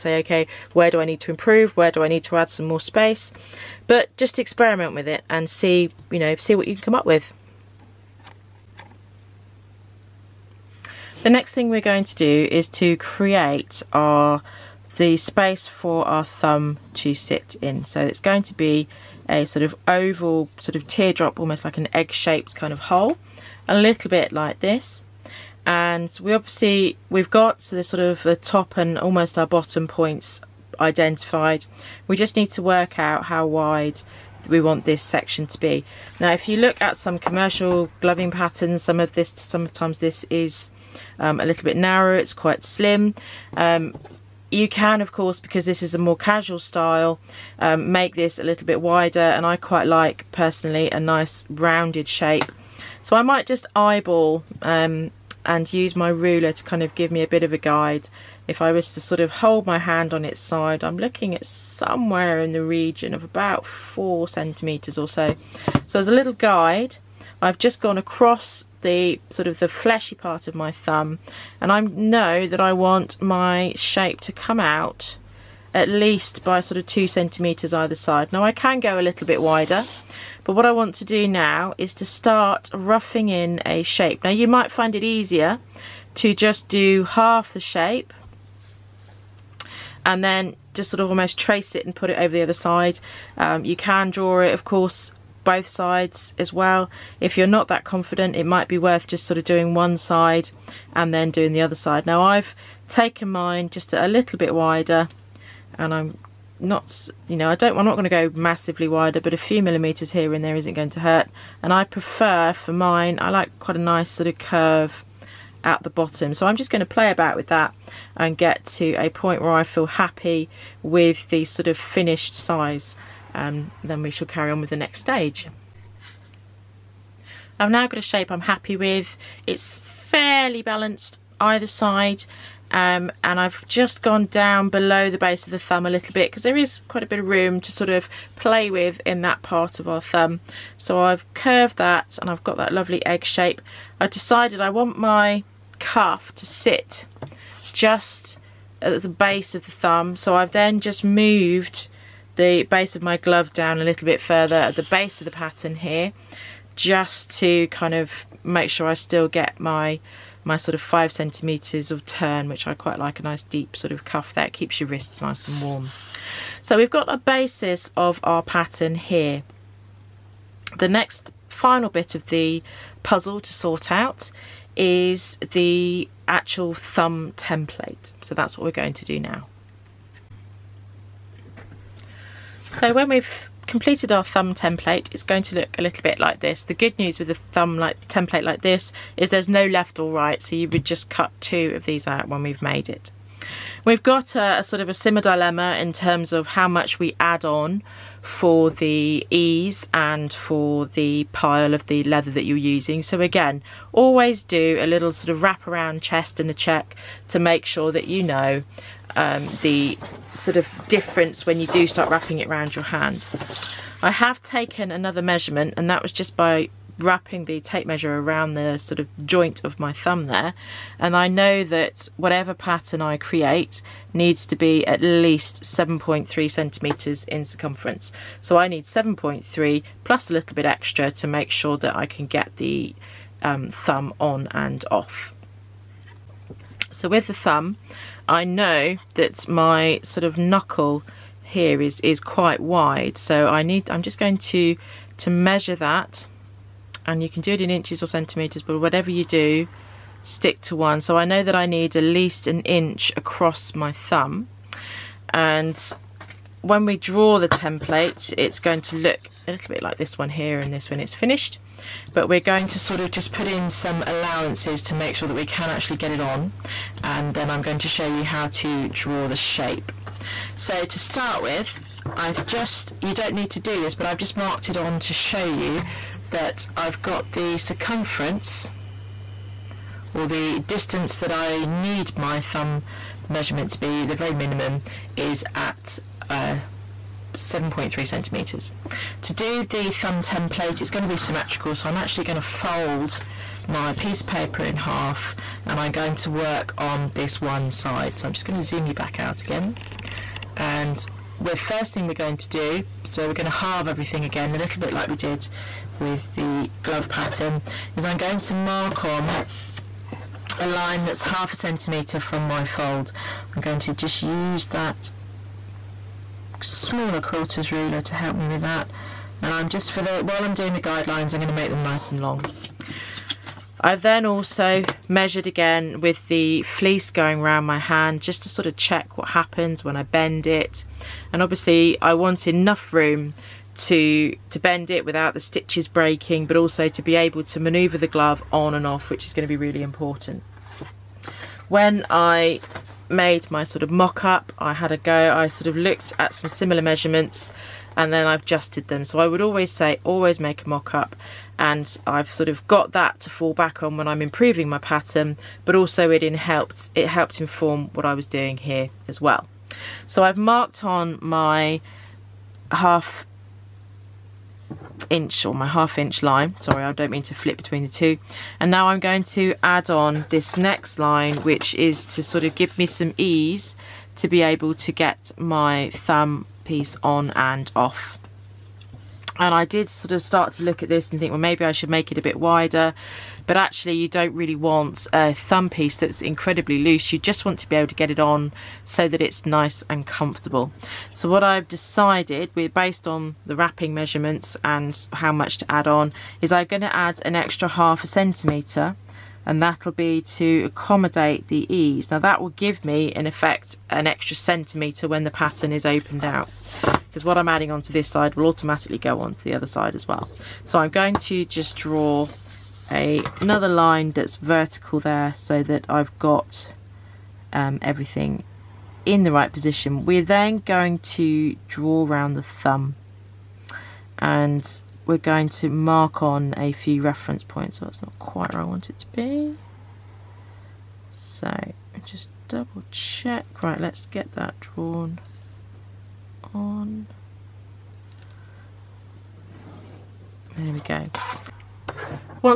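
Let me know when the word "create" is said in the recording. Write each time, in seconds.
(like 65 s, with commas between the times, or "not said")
12 s, 223 s.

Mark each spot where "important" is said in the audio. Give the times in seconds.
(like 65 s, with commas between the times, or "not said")
339 s.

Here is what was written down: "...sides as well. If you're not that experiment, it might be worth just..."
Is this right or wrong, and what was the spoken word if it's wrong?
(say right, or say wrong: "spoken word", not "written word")
wrong: "confident", not "experiment".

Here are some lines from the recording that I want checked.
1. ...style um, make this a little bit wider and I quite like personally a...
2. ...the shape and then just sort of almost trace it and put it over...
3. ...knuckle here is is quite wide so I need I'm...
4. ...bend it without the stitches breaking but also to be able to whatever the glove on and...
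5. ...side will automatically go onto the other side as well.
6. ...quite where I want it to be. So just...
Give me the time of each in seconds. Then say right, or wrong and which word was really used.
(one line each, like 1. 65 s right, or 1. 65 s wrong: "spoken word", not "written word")
1. 46 s right
2. 87 s right
3. 240 s right
4. 334 s wrong: "maneuver", not "whatever"
5. 408 s right
6. 428 s right.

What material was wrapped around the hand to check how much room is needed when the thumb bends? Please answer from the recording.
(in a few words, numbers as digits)
fleece.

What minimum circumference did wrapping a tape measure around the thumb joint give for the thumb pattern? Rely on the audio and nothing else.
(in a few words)
7.3 centimeters.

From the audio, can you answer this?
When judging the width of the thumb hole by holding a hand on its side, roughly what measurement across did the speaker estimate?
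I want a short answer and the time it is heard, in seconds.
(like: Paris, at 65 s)
4 centimetres, at 63 s.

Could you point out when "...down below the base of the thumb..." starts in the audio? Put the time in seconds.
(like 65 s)
134 s.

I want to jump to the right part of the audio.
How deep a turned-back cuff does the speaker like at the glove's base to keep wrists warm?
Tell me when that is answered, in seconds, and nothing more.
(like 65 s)
160 s.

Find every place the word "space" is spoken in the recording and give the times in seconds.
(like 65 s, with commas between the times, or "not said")
2 s, 15 s.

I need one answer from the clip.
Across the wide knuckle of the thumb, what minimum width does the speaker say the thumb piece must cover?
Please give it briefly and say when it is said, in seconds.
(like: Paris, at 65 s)
an inch, at 252 s.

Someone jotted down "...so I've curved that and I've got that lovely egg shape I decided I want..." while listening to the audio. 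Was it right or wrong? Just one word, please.
right.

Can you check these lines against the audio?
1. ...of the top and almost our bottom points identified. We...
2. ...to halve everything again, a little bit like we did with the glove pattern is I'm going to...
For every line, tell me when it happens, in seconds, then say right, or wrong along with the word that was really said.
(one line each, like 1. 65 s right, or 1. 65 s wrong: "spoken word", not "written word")
1. 28 s right
2. 303 s right.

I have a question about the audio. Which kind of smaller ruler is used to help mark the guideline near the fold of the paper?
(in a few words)
quilter's ruler.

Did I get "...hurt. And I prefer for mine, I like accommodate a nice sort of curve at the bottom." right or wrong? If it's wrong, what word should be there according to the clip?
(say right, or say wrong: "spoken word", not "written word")
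wrong: "quite", not "accommodate".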